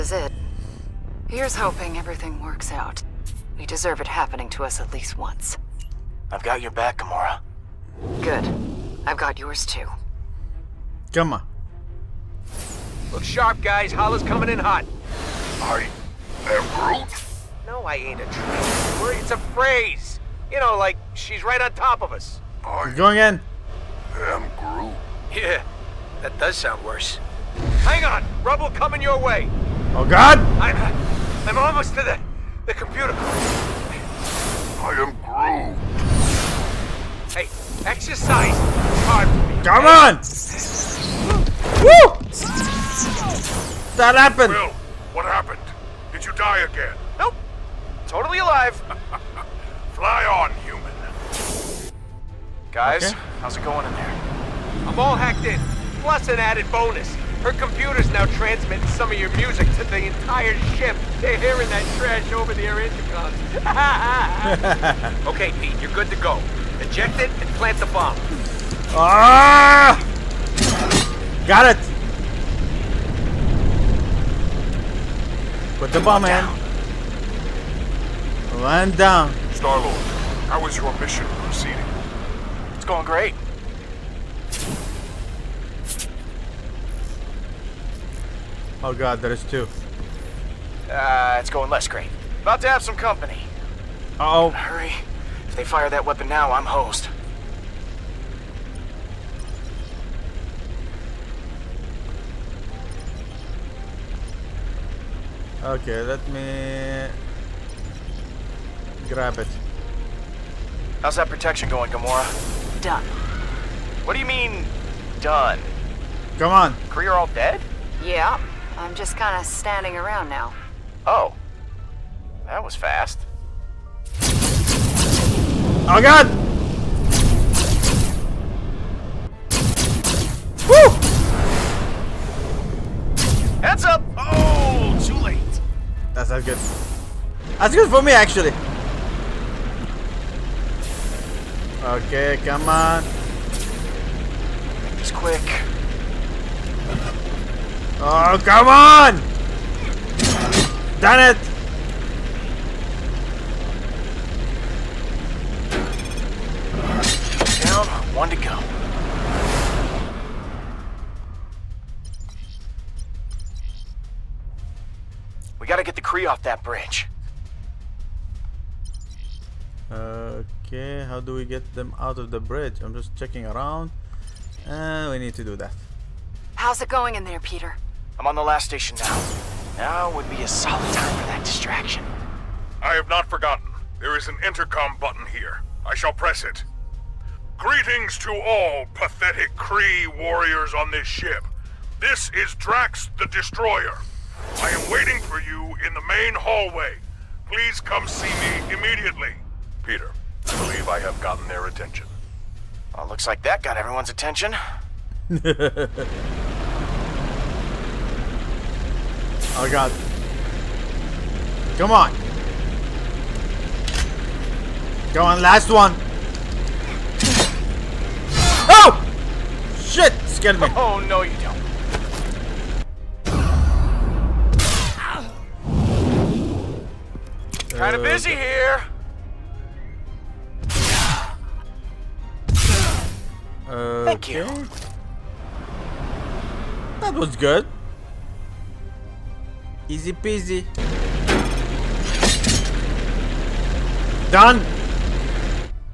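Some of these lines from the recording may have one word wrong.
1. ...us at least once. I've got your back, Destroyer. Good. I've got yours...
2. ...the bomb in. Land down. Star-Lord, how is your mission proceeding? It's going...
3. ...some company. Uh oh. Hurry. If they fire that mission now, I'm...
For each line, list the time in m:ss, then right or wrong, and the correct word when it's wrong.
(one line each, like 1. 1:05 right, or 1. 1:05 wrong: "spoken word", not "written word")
1. 0:04 wrong: "Gamora", not "Destroyer"
2. 1:15 right
3. 1:32 wrong: "weapon", not "mission".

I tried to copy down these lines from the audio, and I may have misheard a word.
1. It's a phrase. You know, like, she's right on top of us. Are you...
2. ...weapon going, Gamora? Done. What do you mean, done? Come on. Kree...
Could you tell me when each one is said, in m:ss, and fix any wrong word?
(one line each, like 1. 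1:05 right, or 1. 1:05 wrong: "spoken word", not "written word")
1. 0:19 right
2. 1:51 wrong: "protection", not "weapon".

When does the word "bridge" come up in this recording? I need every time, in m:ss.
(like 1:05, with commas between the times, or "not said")
2:46, 2:52.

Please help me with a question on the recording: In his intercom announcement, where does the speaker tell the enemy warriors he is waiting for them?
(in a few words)
The main hallway.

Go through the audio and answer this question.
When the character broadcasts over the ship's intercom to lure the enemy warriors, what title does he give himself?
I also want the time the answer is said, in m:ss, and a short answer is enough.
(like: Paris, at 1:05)
Drax the Destroyer, at 3:12.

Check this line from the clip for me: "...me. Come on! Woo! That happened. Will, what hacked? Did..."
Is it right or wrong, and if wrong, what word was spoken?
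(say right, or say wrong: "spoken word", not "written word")
wrong: "happened", not "hacked".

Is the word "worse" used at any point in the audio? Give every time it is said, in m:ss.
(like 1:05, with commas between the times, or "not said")
0:26.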